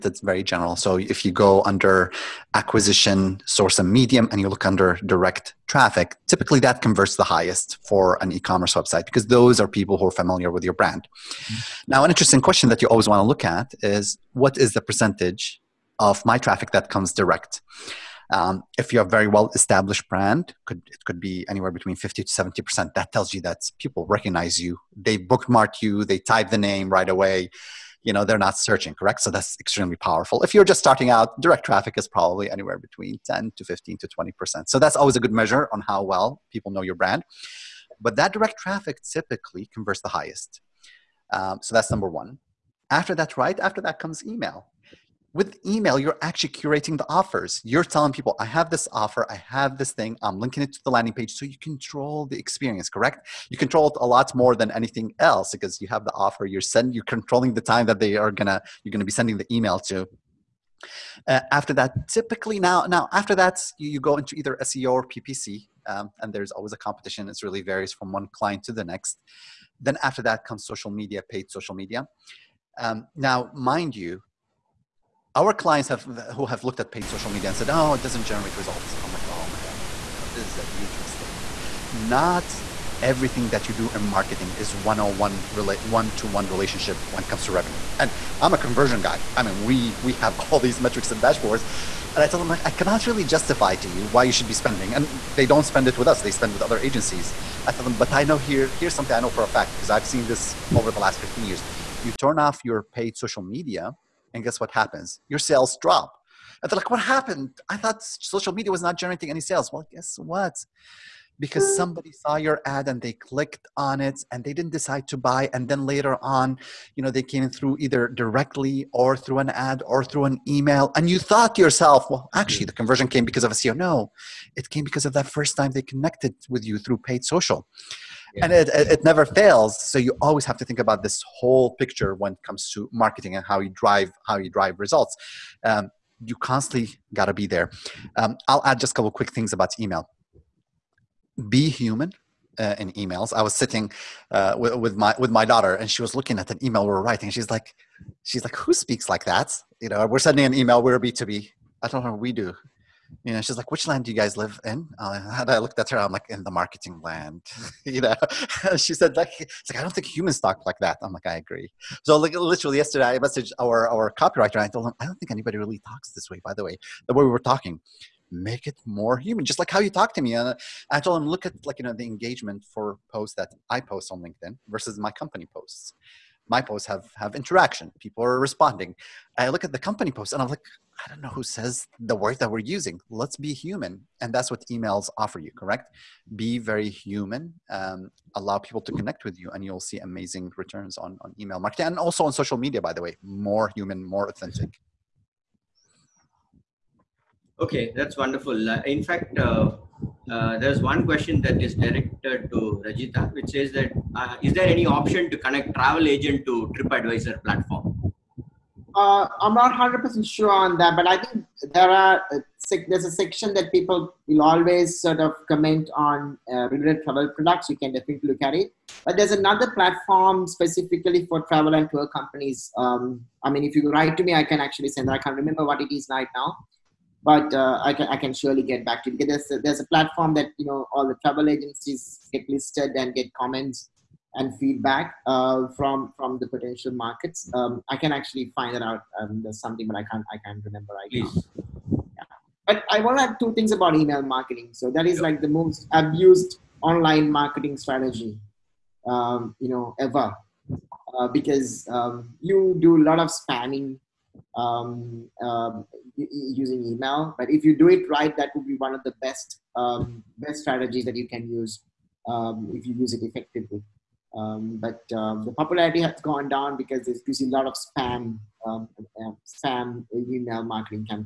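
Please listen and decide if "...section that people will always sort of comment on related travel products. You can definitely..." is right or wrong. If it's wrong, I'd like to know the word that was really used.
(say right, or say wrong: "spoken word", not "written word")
right.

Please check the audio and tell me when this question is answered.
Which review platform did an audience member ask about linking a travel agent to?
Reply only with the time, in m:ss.
3:26.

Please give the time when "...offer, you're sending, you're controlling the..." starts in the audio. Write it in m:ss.
0:56.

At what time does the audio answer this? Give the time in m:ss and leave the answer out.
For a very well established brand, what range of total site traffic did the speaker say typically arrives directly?
0:21.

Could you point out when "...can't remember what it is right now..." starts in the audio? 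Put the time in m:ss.
3:45.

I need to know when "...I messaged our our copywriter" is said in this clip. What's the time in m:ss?
2:43.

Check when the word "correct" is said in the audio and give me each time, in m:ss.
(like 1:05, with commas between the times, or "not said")
0:28, 0:52, 3:05.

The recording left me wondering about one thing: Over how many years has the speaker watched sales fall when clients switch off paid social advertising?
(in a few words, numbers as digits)
15 years.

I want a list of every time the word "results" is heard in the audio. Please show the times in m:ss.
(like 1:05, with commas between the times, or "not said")
1:18, 2:14.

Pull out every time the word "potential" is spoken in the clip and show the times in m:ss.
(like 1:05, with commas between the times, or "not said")
3:56.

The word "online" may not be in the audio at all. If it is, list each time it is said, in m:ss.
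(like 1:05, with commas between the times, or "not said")
4:06.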